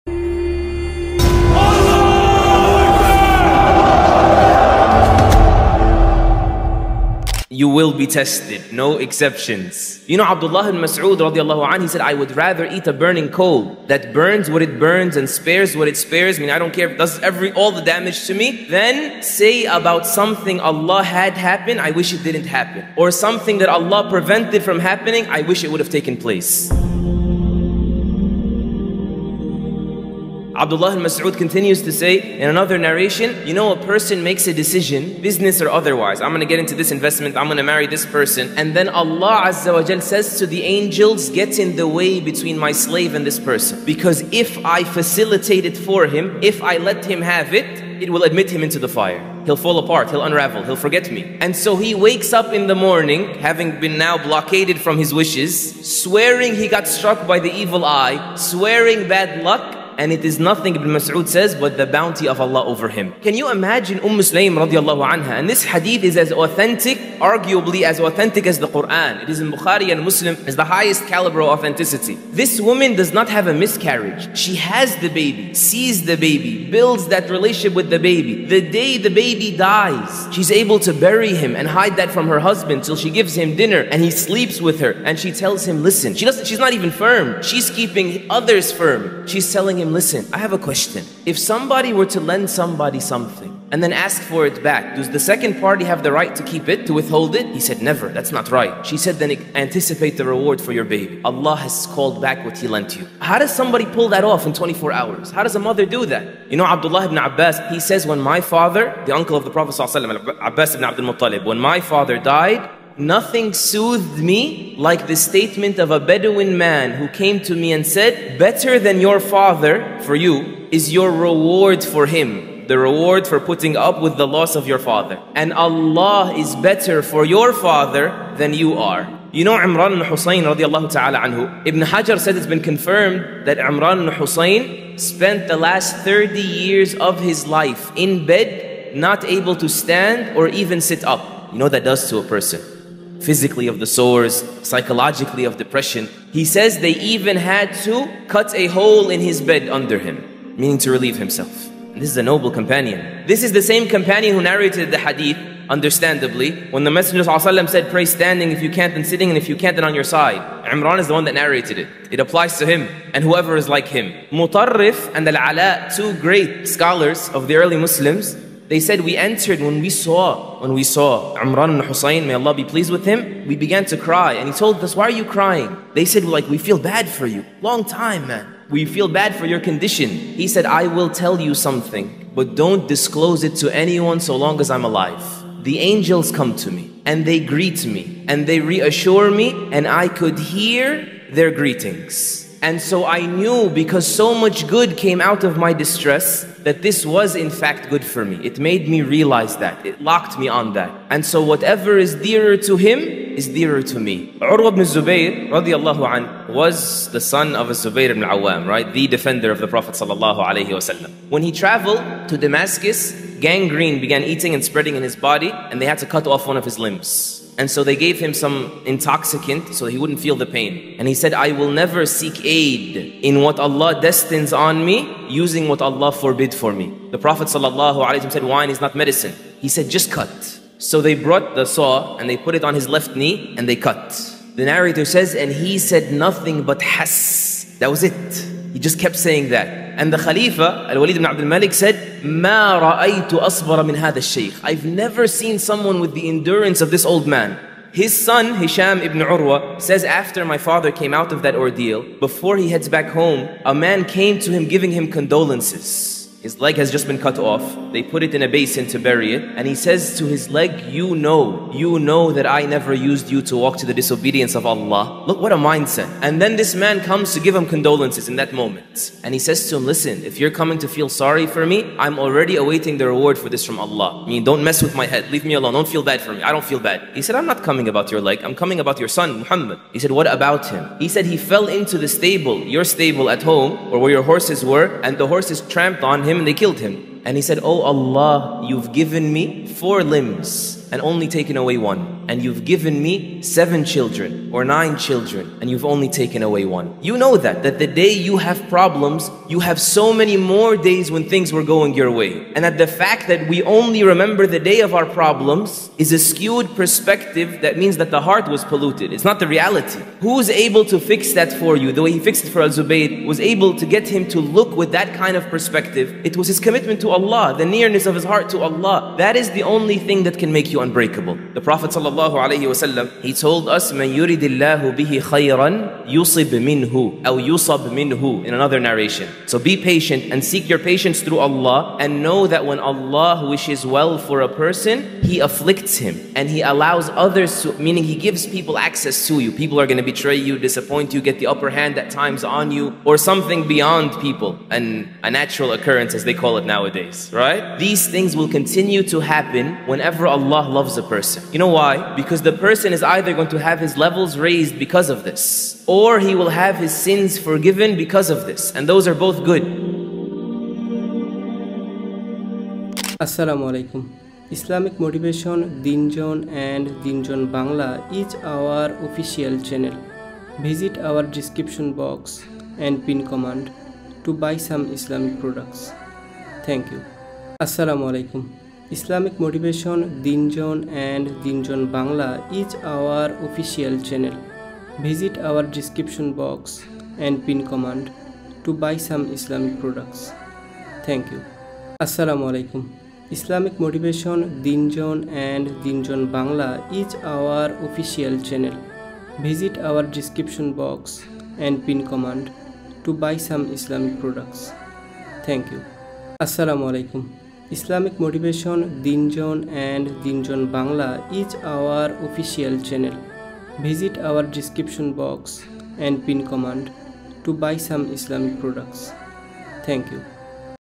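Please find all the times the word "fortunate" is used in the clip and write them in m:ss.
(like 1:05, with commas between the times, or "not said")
not said.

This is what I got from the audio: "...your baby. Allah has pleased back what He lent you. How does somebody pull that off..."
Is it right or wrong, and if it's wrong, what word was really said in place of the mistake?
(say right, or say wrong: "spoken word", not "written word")
wrong: "called", not "pleased".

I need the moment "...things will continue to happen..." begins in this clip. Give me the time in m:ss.
5:48.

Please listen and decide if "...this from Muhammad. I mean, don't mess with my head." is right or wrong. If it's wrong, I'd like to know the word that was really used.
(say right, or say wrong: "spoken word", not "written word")
wrong: "Allah", not "Muhammad".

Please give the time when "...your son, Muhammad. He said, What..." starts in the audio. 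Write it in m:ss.
4:38.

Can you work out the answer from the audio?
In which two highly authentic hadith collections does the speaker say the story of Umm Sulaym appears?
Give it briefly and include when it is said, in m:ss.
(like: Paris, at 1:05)
Bukhari and Muslim, at 1:09.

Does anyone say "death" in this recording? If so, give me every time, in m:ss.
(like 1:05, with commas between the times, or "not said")
not said.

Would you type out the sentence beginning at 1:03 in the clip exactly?
Can you imagine Umm Sulaym radiallahu anha?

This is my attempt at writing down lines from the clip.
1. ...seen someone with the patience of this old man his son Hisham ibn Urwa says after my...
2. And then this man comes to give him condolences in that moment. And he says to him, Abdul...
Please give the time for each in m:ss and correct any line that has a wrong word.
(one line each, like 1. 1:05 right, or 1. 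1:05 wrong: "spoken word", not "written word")
1. 4:05 wrong: "endurance", not "patience"
2. 4:26 wrong: "Listen", not "Abdul".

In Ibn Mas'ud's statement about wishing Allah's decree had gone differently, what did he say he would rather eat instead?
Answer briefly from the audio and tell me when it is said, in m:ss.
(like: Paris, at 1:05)
A burning coal, at 0:12.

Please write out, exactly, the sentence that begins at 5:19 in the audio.
That is the only thing that can make you unbreakable.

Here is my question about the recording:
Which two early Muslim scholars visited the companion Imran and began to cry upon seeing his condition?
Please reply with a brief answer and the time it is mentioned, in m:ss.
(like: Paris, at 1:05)
Mutarrif and Al Ala, at 2:44.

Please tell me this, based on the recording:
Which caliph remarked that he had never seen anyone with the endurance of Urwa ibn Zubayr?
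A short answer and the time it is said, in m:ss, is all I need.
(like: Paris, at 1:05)
Al Walid ibn Abdul Malik, at 4:00.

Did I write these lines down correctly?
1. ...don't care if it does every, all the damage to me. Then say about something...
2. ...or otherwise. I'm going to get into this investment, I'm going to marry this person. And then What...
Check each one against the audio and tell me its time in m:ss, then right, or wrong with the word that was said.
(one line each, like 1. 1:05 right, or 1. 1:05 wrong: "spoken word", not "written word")
1. 0:16 right
2. 0:35 wrong: "Allah", not "What".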